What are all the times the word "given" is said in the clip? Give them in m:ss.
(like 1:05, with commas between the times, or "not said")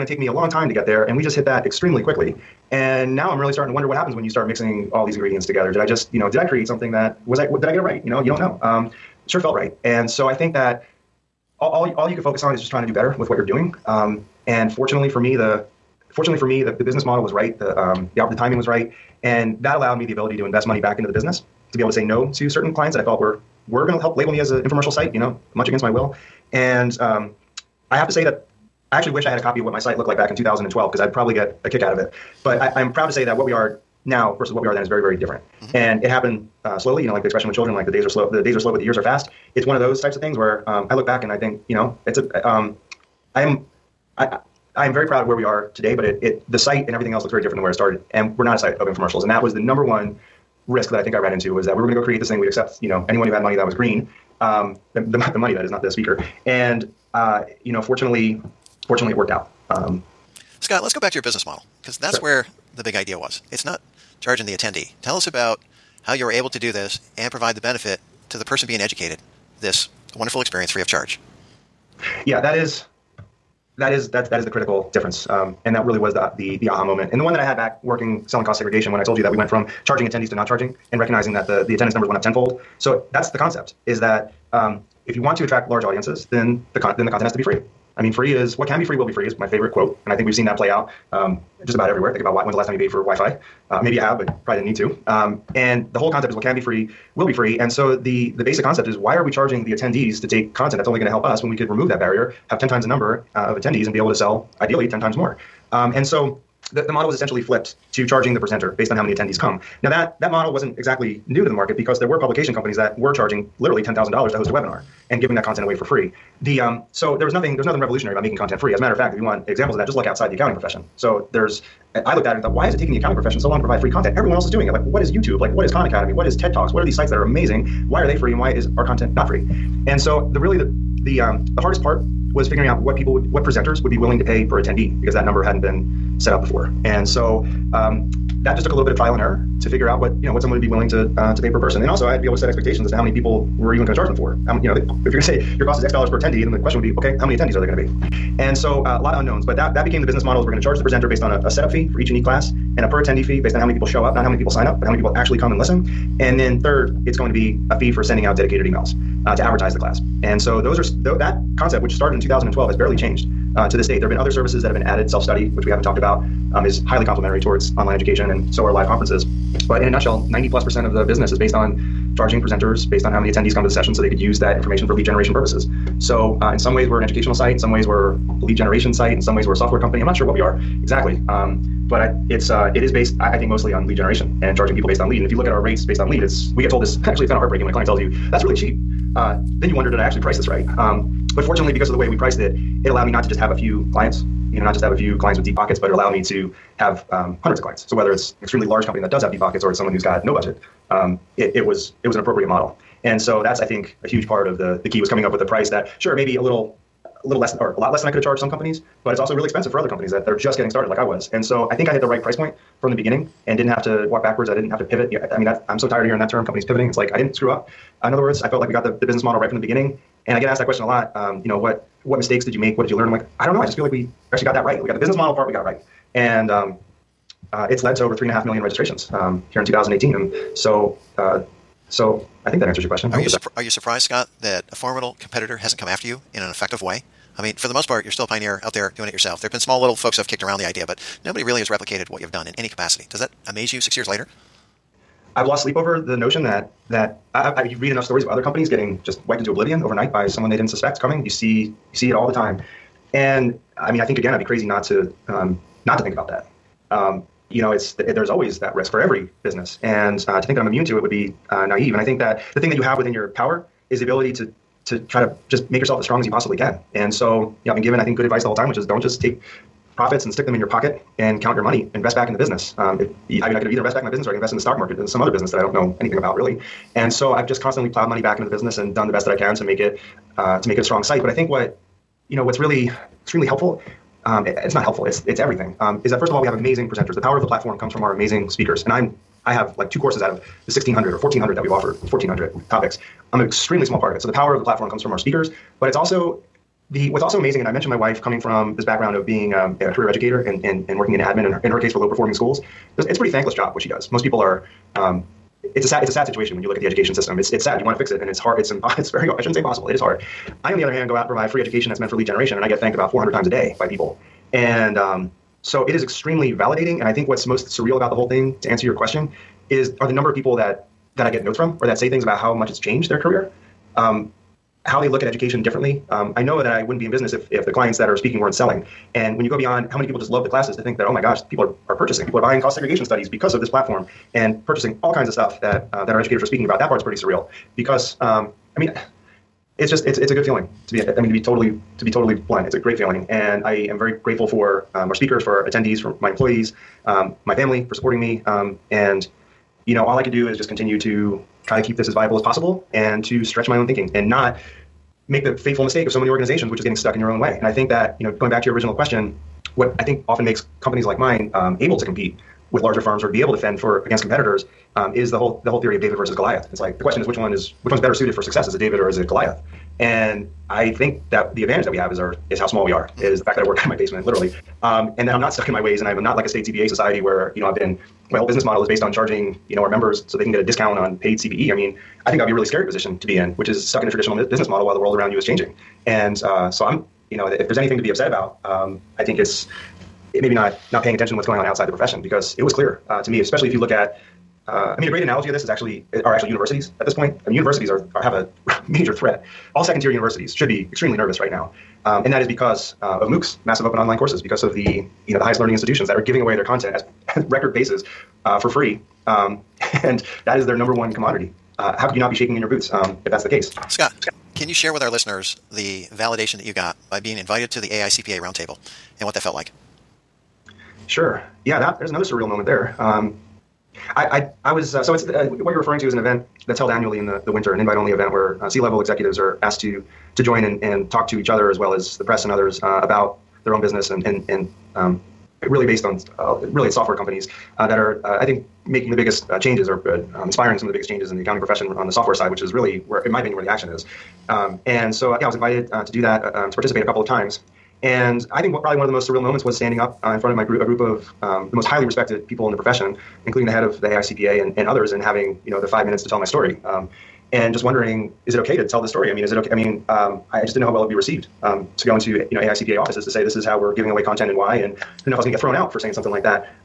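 4:27.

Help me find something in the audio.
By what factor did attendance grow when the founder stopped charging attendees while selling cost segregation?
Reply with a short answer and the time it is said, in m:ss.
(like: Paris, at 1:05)
tenfold, at 1:22.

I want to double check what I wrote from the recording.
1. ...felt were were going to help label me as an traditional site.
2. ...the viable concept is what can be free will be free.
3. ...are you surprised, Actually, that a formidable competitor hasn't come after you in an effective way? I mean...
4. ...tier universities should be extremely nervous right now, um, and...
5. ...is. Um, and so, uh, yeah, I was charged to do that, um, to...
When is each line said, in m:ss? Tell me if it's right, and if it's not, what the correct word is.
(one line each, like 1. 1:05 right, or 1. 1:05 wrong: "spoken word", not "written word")
1. 0:23 wrong: "infomercial", not "traditional"
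2. 1:35 wrong: "whole", not "viable"
3. 3:53 wrong: "Scott", not "Actually"
4. 6:40 right
5. 7:23 wrong: "invited", not "charged".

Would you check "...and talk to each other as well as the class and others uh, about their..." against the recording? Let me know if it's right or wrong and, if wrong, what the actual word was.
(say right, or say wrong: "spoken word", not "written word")
wrong: "press", not "class".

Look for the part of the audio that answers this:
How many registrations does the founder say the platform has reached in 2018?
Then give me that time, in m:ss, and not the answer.
3:48.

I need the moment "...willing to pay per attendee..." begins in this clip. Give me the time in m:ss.
2:13.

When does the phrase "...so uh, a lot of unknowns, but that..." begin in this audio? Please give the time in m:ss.
2:28.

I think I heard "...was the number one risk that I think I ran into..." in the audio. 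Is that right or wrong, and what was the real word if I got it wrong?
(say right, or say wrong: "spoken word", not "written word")
right.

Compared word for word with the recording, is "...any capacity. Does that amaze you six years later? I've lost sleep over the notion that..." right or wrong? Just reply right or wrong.
right.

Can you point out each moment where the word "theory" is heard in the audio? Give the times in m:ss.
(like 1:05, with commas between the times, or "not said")
6:05.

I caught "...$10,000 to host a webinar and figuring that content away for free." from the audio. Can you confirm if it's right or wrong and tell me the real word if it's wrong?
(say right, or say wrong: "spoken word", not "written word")
wrong: "giving", not "figuring".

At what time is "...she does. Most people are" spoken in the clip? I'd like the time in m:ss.
5:03.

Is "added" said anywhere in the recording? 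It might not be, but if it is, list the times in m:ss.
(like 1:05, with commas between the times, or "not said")
2:44.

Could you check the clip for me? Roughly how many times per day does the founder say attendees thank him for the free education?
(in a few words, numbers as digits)
400.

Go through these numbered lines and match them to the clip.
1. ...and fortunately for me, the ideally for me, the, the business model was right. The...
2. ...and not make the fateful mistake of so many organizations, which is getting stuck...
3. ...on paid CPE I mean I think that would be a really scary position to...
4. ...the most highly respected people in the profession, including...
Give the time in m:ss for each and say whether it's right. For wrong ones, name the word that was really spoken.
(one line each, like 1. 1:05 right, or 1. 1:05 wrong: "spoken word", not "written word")
1. 0:14 wrong: "fortunately", not "ideally"
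2. 5:54 right
3. 6:20 right
4. 7:31 right.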